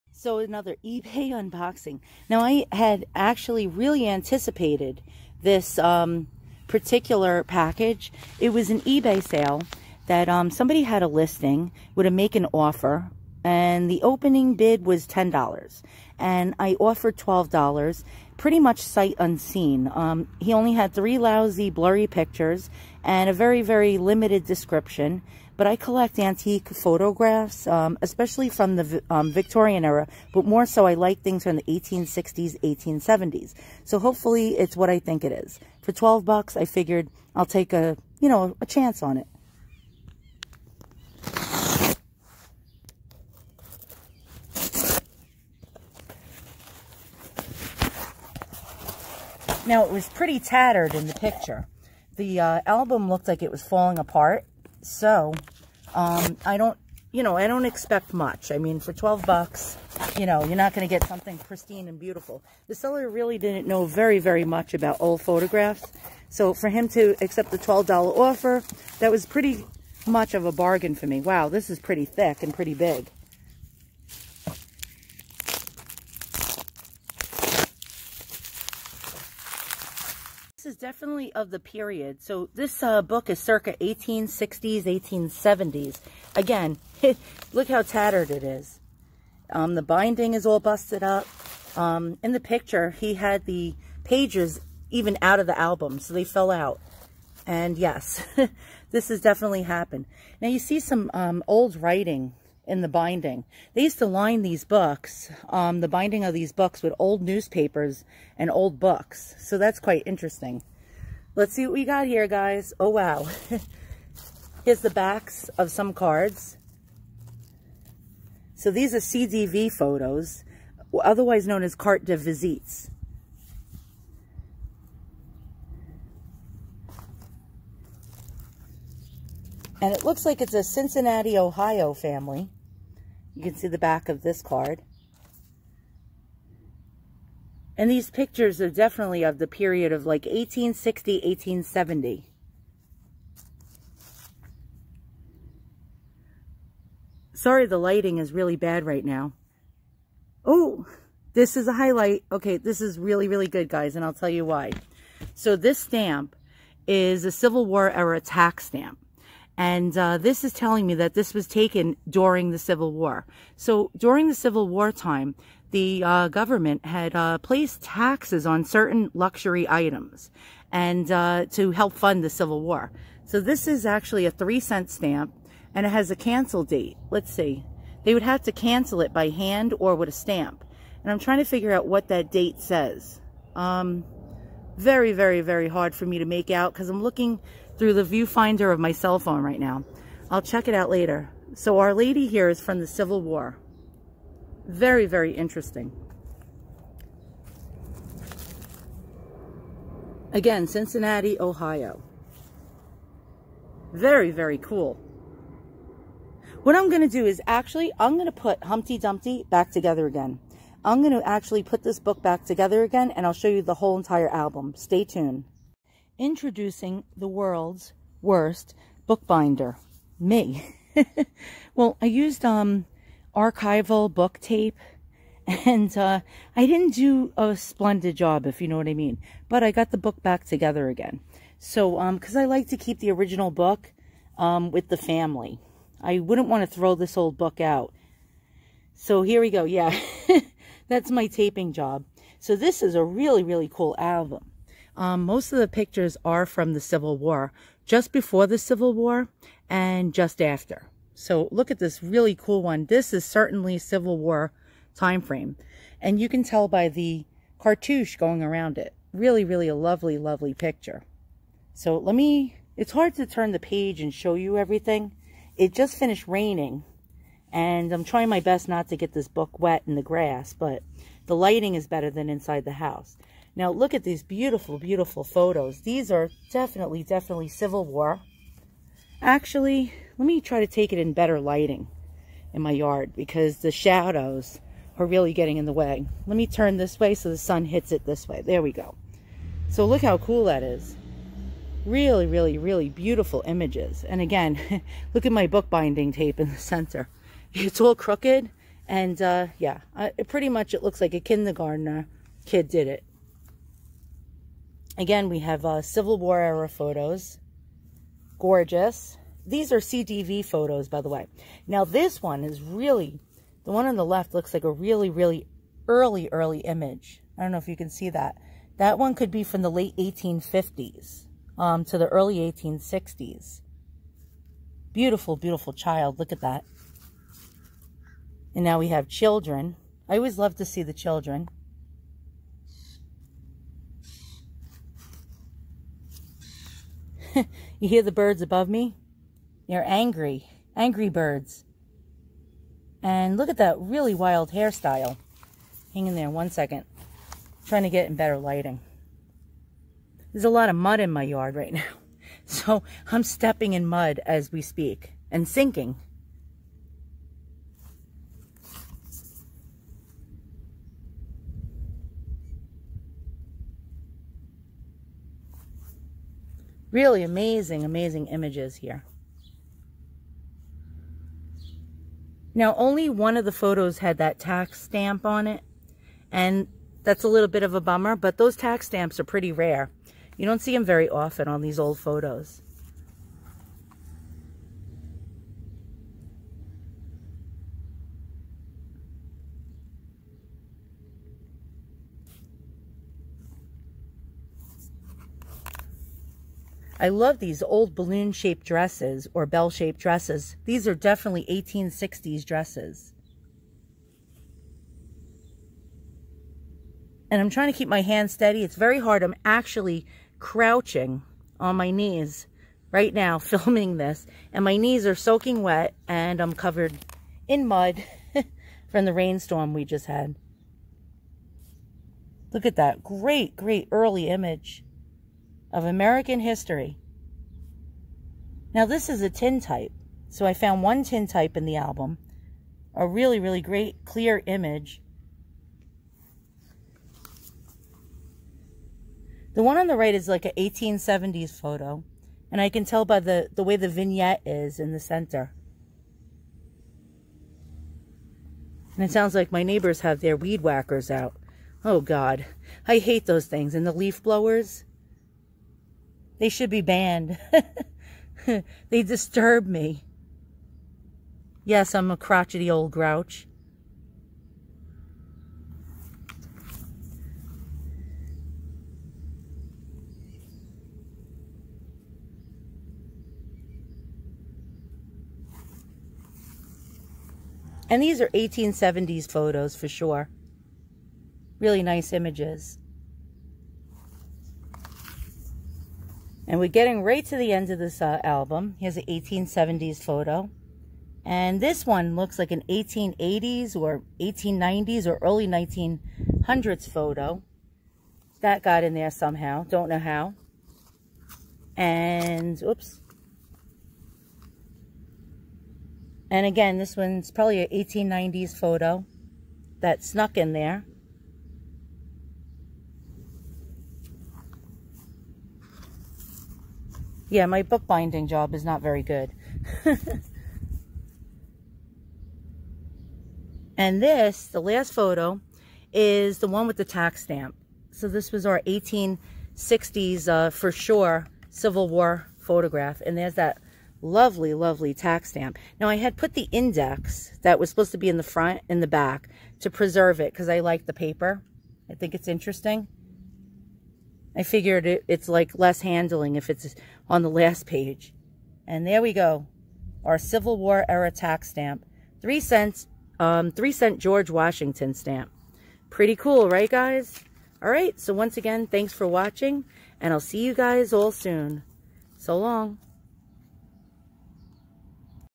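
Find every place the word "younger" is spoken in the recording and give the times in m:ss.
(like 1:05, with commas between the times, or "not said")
not said.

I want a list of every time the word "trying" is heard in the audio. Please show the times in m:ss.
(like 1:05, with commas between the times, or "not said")
3:01, 4:28, 5:47, 6:47.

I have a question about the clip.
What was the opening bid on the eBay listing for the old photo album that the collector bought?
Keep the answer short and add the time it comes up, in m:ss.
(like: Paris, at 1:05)
$10, at 0:15.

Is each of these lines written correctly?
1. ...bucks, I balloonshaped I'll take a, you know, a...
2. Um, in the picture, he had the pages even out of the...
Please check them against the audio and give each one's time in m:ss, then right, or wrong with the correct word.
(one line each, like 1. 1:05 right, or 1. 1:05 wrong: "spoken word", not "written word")
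1. 0:36 wrong: "figured", not "balloonshaped"
2. 1:31 right.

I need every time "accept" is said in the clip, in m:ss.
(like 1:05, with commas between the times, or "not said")
1:07.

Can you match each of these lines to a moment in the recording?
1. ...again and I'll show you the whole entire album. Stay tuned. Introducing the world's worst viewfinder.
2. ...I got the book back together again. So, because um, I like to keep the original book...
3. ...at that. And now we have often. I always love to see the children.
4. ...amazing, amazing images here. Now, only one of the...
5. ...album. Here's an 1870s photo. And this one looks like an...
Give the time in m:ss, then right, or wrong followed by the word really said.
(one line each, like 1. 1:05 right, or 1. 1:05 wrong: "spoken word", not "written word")
1. 3:32 wrong: "bookbinder", not "viewfinder"
2. 3:49 right
3. 5:26 wrong: "children", not "often"
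4. 6:07 right
5. 8:08 right.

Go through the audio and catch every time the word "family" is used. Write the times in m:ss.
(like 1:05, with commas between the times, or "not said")
2:11, 3:54.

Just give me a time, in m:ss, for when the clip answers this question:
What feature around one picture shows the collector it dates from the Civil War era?
4:17.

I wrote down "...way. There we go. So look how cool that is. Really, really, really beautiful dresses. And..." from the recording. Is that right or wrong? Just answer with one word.
wrong.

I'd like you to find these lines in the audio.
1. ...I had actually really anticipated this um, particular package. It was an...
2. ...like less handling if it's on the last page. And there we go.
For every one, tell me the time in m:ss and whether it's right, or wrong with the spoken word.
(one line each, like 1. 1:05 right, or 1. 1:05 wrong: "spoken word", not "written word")
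1. 0:02 right
2. 9:05 right.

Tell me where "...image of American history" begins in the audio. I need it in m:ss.
7:04.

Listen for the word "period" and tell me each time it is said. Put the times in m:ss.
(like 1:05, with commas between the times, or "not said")
1:21, 2:19.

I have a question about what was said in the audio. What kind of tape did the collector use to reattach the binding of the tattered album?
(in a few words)
archival book tape.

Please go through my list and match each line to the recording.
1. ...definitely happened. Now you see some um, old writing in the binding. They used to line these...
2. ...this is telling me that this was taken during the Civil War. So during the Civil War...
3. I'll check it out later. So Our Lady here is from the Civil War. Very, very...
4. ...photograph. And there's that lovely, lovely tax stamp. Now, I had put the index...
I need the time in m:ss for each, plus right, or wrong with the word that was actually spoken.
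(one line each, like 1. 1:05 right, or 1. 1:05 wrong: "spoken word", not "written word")
1. 1:39 right
2. 2:40 right
3. 3:10 right
4. 8:52 right.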